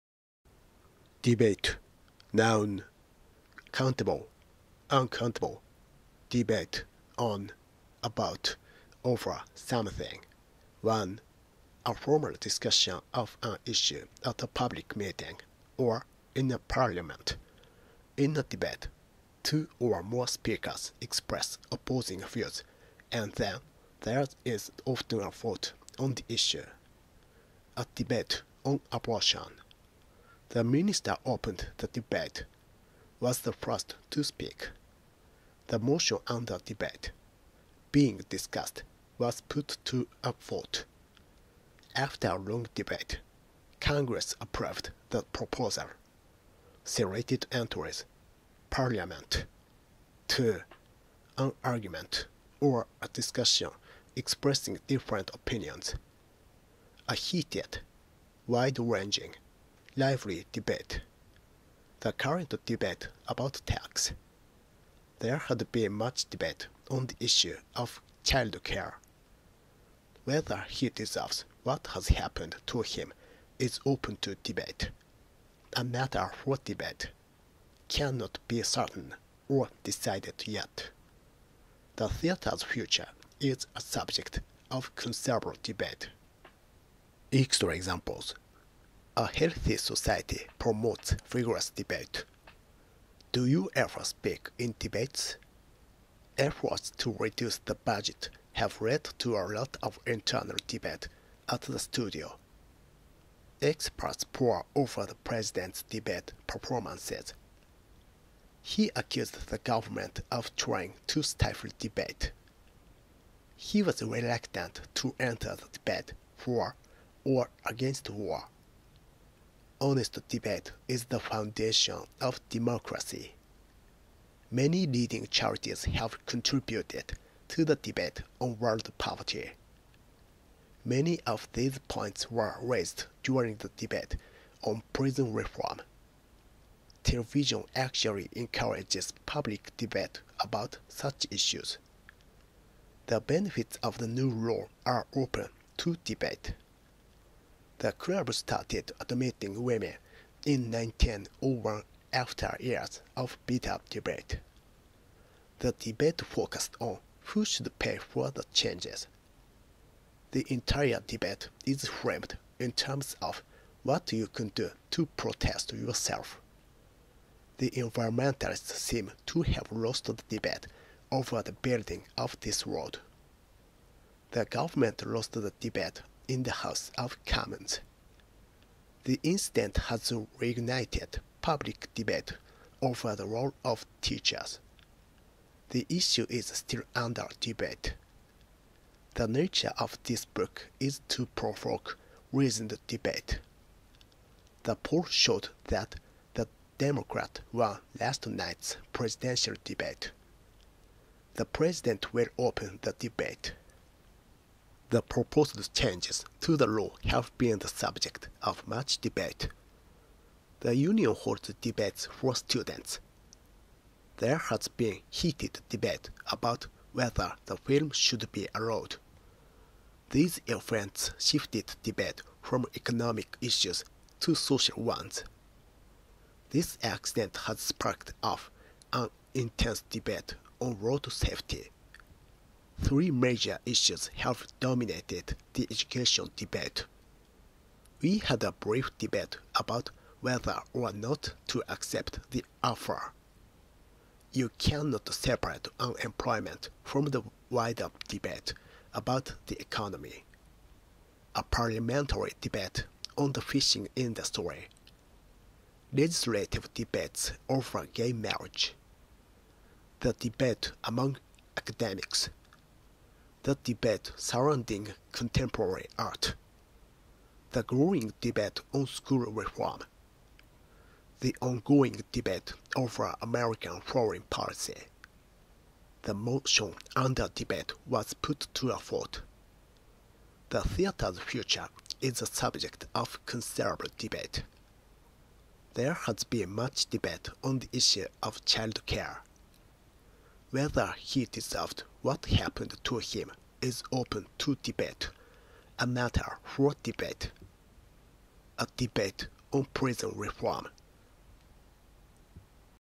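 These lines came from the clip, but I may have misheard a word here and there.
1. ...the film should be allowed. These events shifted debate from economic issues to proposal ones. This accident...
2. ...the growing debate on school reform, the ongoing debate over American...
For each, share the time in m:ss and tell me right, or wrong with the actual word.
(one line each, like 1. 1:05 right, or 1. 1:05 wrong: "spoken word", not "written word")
1. 3:37 wrong: "social", not "proposal"
2. 4:27 right.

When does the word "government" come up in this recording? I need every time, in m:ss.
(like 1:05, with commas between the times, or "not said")
1:49, 2:54.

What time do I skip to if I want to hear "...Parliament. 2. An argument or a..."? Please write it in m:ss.
0:48.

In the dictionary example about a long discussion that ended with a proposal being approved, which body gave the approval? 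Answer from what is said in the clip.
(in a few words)
Congress.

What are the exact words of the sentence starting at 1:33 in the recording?
Do you ever speak in debates?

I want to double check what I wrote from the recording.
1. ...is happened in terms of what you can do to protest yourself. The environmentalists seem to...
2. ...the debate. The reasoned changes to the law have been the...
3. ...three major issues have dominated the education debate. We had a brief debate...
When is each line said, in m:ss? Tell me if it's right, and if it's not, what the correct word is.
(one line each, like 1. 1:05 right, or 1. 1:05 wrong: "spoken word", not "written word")
1. 2:41 wrong: "framed", not "happened"
2. 3:22 wrong: "proposed", not "reasoned"
3. 3:52 right.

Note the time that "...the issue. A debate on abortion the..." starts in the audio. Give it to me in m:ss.
0:26.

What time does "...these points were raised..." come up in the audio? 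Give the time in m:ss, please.
2:11.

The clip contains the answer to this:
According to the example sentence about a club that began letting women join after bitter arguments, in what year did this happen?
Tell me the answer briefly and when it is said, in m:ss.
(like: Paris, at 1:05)
1901, at 2:30.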